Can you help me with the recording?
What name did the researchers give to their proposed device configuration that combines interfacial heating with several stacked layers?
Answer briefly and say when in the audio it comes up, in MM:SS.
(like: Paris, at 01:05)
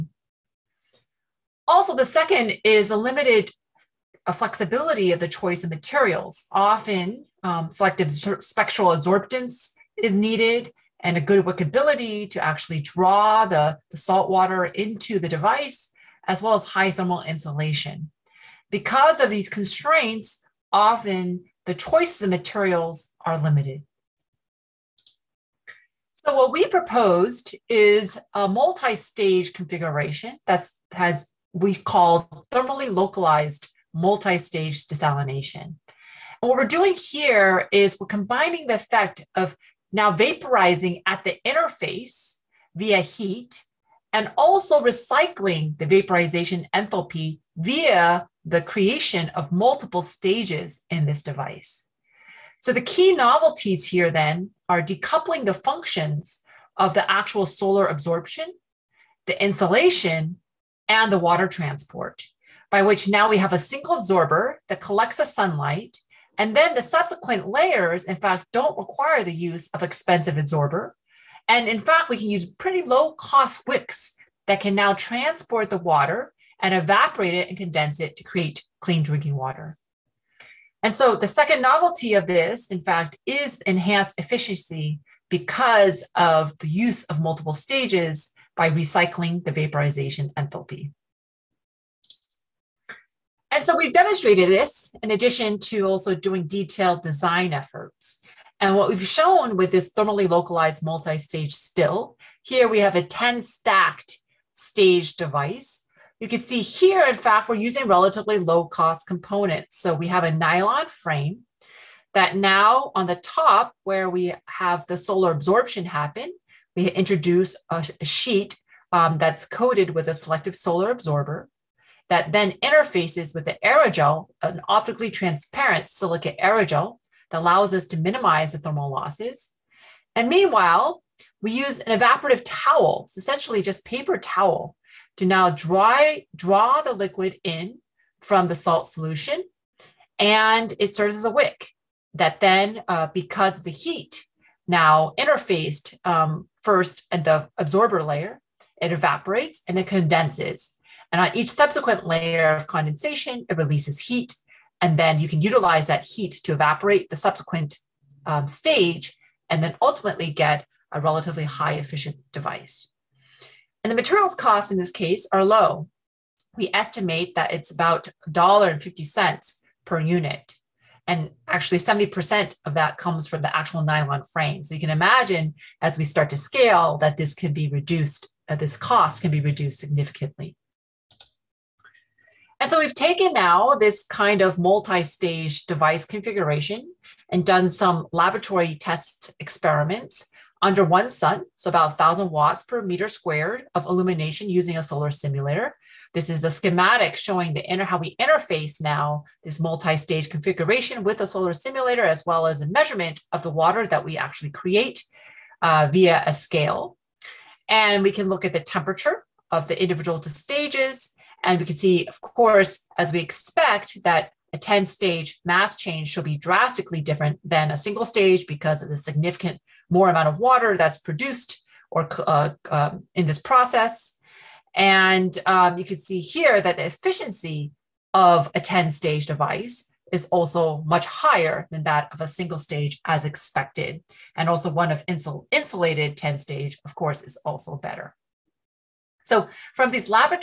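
Thermally localized multi-stage desalination, at 00:32.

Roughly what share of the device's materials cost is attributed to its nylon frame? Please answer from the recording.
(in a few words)
70%.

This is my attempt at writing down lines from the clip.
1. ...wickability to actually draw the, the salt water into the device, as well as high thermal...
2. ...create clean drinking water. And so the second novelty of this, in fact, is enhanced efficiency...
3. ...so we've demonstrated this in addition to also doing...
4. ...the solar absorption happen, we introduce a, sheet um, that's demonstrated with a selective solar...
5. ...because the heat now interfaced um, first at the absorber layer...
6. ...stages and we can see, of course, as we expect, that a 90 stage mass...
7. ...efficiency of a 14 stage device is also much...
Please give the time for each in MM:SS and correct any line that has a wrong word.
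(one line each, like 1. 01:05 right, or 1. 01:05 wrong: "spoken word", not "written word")
1. 00:11 right
2. 01:18 right
3. 01:33 right
4. 01:54 wrong: "coated", not "demonstrated"
5. 02:23 right
6. 03:30 wrong: "10", not "90"
7. 03:46 wrong: "10", not "14".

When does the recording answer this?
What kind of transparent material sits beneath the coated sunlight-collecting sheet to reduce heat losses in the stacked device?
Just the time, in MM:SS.
02:05.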